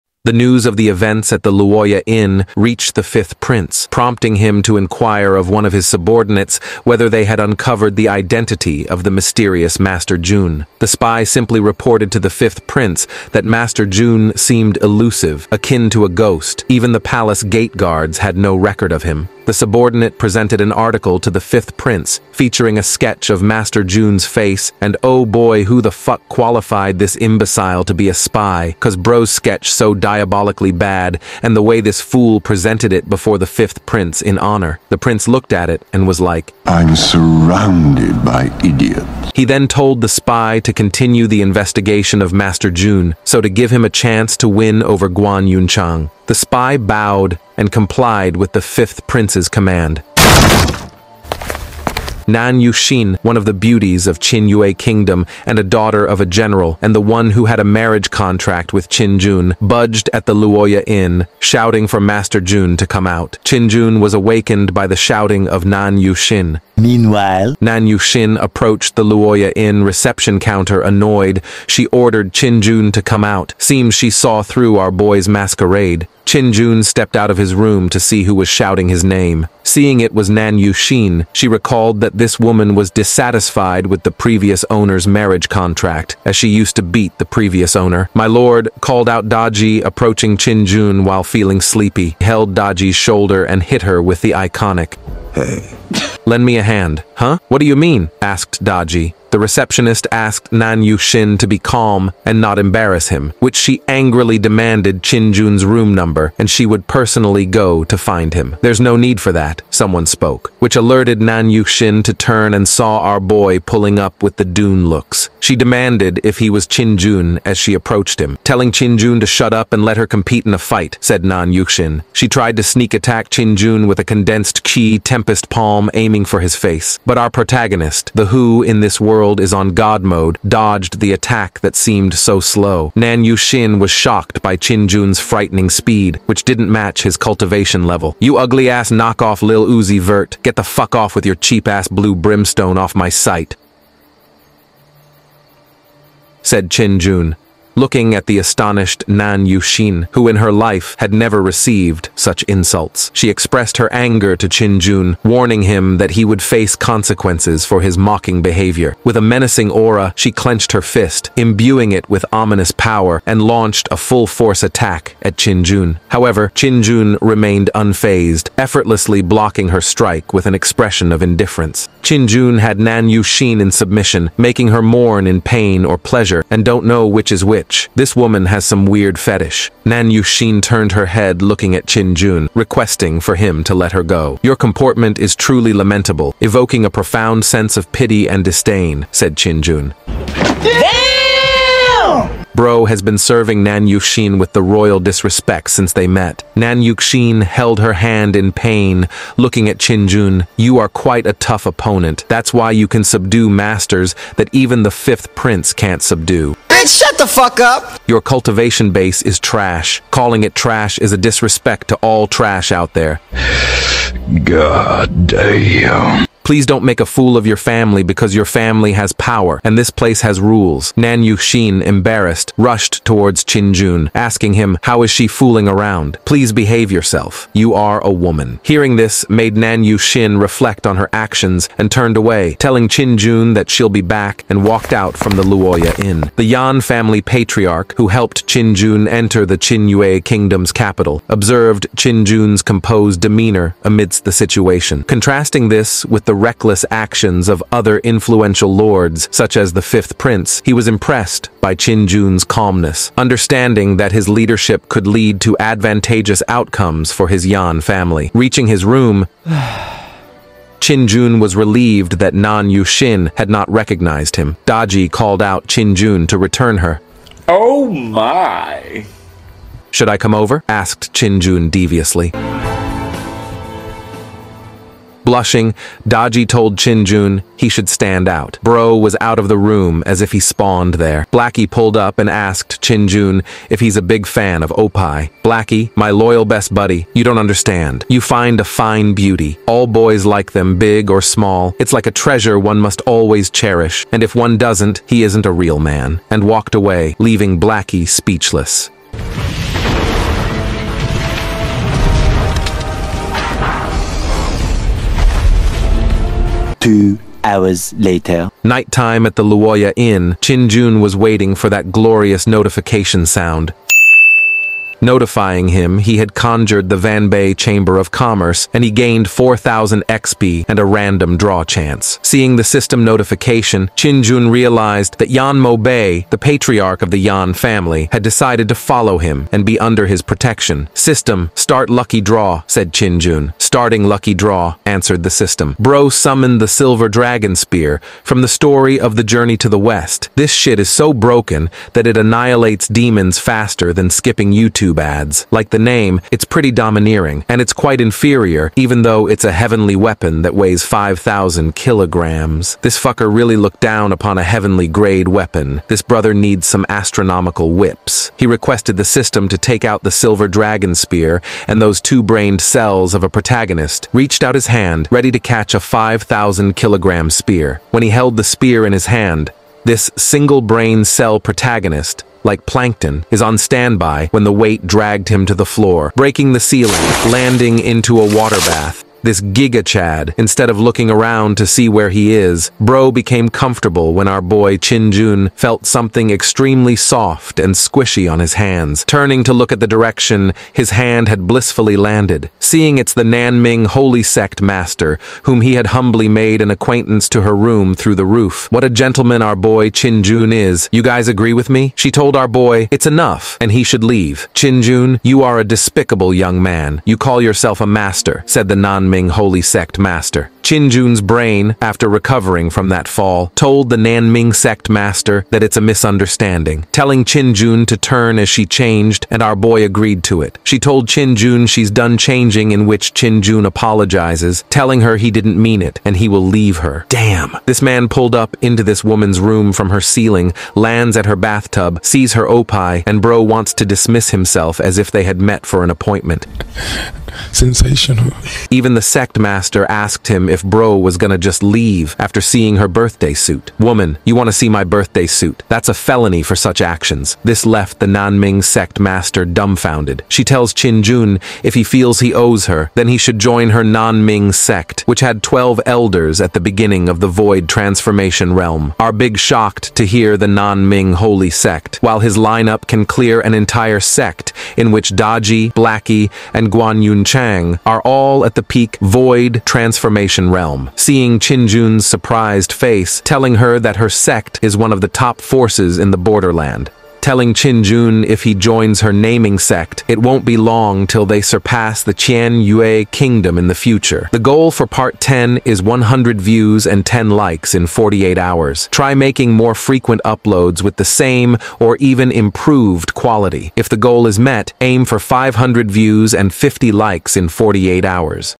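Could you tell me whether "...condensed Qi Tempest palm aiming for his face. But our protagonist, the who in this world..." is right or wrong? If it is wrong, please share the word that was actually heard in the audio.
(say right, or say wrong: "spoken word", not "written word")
right.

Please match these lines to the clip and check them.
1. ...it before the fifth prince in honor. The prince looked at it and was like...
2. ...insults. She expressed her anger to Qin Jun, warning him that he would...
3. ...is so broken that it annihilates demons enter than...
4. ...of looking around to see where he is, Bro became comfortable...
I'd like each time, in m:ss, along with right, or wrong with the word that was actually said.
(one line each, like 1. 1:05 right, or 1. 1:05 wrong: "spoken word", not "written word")
1. 0:32 right
2. 2:32 right
3. 5:40 wrong: "faster", not "enter"
4. 6:20 right.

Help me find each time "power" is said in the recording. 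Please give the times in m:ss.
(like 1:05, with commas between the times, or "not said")
2:42, 3:39.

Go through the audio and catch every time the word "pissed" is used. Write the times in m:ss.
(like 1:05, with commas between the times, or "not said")
not said.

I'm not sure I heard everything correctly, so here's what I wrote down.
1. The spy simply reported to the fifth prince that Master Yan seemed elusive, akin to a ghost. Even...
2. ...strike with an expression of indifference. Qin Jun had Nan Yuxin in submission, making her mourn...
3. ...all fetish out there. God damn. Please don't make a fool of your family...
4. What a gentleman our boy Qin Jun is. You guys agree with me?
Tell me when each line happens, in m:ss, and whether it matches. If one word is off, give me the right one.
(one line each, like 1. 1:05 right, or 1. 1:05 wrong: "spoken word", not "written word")
1. 0:10 wrong: "Jun", not "Yan"
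2. 2:49 right
3. 3:31 wrong: "trash", not "fetish"
4. 6:38 right.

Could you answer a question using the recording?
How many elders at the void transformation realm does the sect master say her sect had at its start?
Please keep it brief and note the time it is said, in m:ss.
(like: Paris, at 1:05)
12, at 7:35.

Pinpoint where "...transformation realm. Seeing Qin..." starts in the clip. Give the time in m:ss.
7:49.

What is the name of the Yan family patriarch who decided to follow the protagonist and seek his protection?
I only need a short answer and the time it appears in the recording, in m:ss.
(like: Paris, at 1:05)
Yan Mo Bei, at 5:25.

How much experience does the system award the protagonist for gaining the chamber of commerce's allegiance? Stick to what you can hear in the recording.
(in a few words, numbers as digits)
4,000 XP.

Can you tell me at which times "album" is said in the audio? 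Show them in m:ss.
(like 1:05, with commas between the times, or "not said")
not said.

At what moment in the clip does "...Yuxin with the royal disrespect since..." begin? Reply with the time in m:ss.
3:13.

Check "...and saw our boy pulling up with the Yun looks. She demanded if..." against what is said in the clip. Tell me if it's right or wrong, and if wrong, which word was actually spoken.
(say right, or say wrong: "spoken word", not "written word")
wrong: "Dune", not "Yun".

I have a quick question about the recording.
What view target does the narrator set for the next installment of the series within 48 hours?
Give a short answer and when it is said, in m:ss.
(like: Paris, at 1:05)
100 views, at 8:05.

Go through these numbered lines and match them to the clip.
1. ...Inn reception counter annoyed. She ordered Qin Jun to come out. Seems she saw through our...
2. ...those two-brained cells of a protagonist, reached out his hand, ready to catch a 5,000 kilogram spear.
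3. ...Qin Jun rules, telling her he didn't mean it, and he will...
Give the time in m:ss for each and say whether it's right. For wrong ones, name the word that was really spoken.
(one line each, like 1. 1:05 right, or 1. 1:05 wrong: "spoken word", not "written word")
1. 1:09 right
2. 6:01 right
3. 7:03 wrong: "apologizes", not "rules".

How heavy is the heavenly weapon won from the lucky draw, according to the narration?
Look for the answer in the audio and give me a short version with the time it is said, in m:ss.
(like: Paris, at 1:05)
5,000 kilograms, at 5:50.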